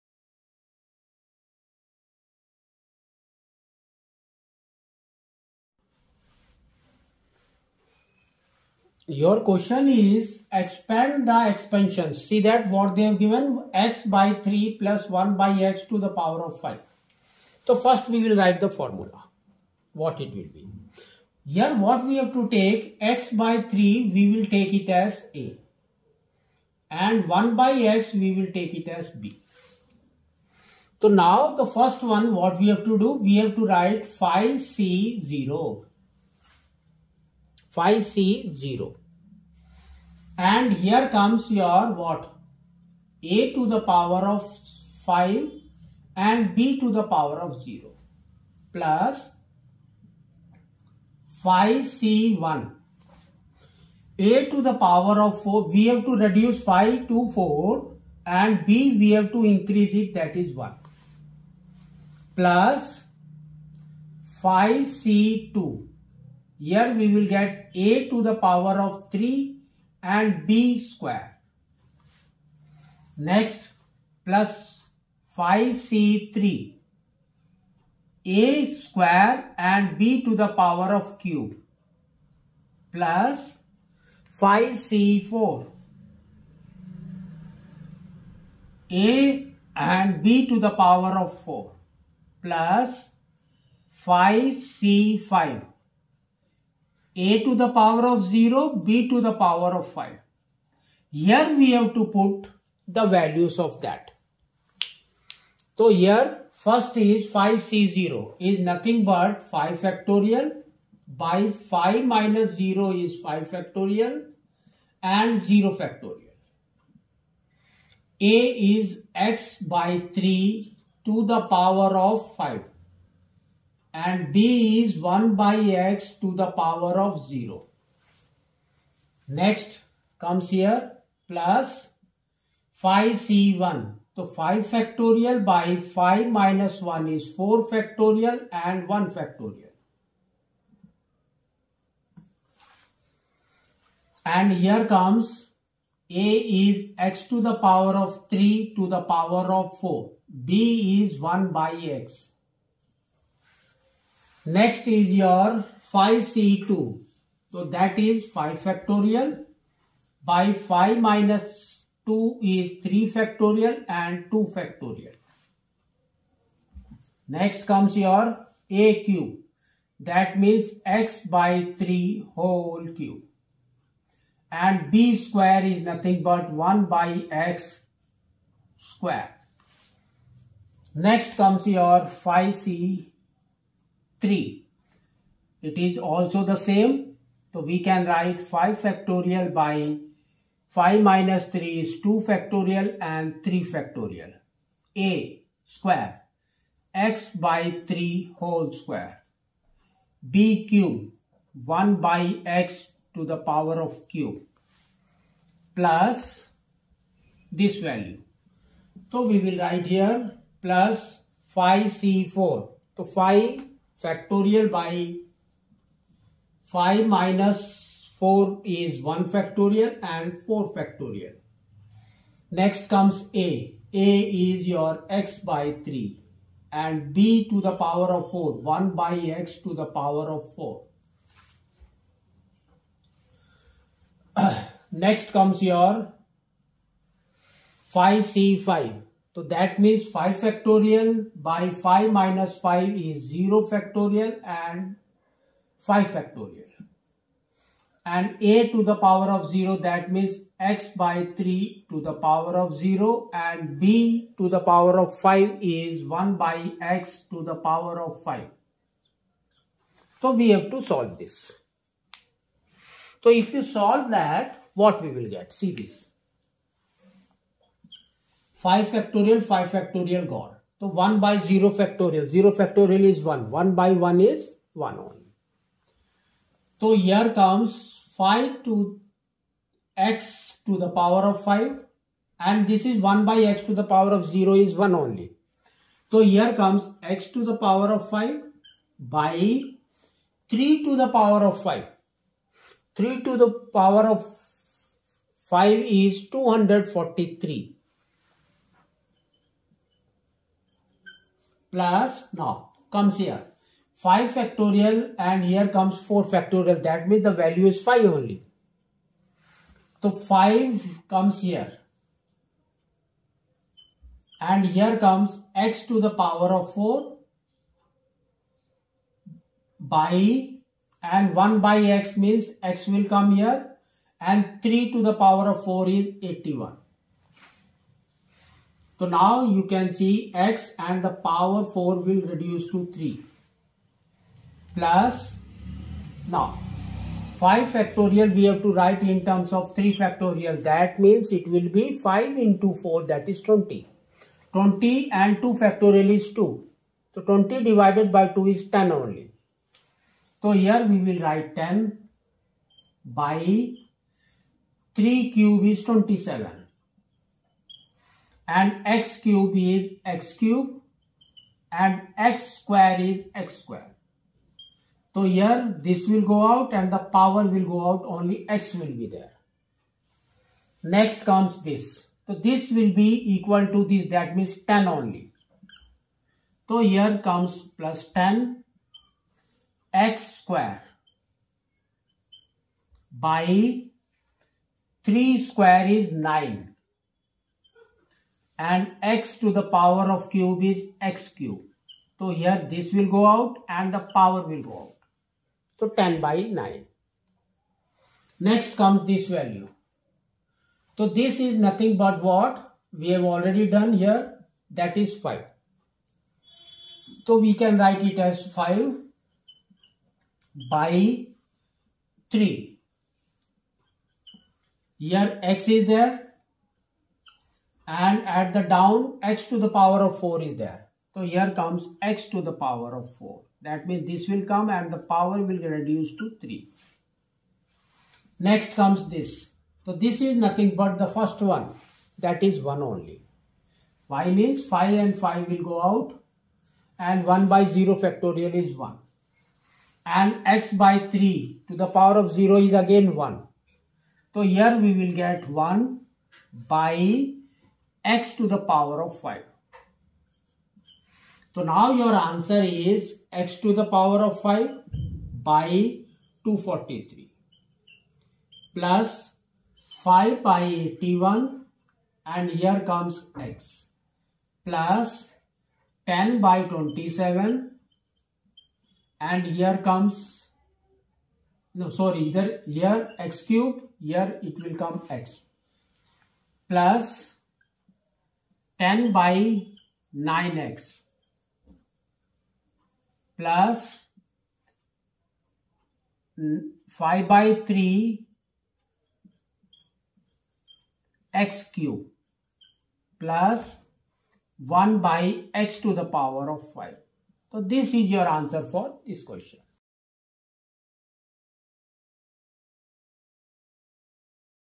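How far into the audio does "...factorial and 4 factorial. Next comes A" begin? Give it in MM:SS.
03:39.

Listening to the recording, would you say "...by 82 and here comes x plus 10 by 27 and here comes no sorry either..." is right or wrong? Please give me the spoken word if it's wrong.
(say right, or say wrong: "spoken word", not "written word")
wrong: "81", not "82".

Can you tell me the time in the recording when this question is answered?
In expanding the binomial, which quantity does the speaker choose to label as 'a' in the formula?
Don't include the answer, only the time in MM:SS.
00:23.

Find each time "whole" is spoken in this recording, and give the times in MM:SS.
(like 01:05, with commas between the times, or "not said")
02:52, 03:18.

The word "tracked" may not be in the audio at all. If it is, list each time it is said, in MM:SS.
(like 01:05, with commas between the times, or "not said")
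not said.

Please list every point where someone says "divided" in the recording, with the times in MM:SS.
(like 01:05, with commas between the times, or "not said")
05:47.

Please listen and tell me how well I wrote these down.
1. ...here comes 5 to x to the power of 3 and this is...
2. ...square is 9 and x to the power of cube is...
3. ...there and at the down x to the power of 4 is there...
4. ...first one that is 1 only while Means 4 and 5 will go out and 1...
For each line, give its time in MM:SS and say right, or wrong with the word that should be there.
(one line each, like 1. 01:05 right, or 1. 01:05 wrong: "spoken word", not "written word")
1. 04:36 wrong: "5", not "3"
2. 06:25 right
3. 06:55 right
4. 07:11 wrong: "5", not "4".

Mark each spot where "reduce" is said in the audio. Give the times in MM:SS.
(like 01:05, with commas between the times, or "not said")
00:56, 05:32, 07:05.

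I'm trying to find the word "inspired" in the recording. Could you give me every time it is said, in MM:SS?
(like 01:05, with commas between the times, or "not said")
not said.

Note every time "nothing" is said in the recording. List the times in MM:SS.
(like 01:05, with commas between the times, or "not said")
01:48, 02:55, 06:41, 07:10.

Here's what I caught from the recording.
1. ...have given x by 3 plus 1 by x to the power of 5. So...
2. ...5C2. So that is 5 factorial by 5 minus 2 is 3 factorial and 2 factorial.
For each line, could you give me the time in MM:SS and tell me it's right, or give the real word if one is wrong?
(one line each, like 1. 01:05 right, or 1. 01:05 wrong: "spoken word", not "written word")
1. 00:13 right
2. 02:35 right.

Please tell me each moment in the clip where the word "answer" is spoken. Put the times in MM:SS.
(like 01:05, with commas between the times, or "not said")
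07:32, 08:18.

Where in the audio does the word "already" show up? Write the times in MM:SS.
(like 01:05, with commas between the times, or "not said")
06:43.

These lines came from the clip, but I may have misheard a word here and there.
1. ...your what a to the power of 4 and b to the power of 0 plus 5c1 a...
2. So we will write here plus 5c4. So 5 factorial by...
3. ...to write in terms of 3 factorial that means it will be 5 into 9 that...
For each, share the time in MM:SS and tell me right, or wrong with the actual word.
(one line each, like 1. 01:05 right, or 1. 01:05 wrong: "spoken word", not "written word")
1. 00:41 wrong: "5", not "4"
2. 03:29 right
3. 05:38 wrong: "4", not "9".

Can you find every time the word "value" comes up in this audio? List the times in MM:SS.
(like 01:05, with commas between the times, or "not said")
01:43, 03:27, 05:07, 06:39.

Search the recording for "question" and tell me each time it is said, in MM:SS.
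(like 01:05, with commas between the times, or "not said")
00:09, 08:19.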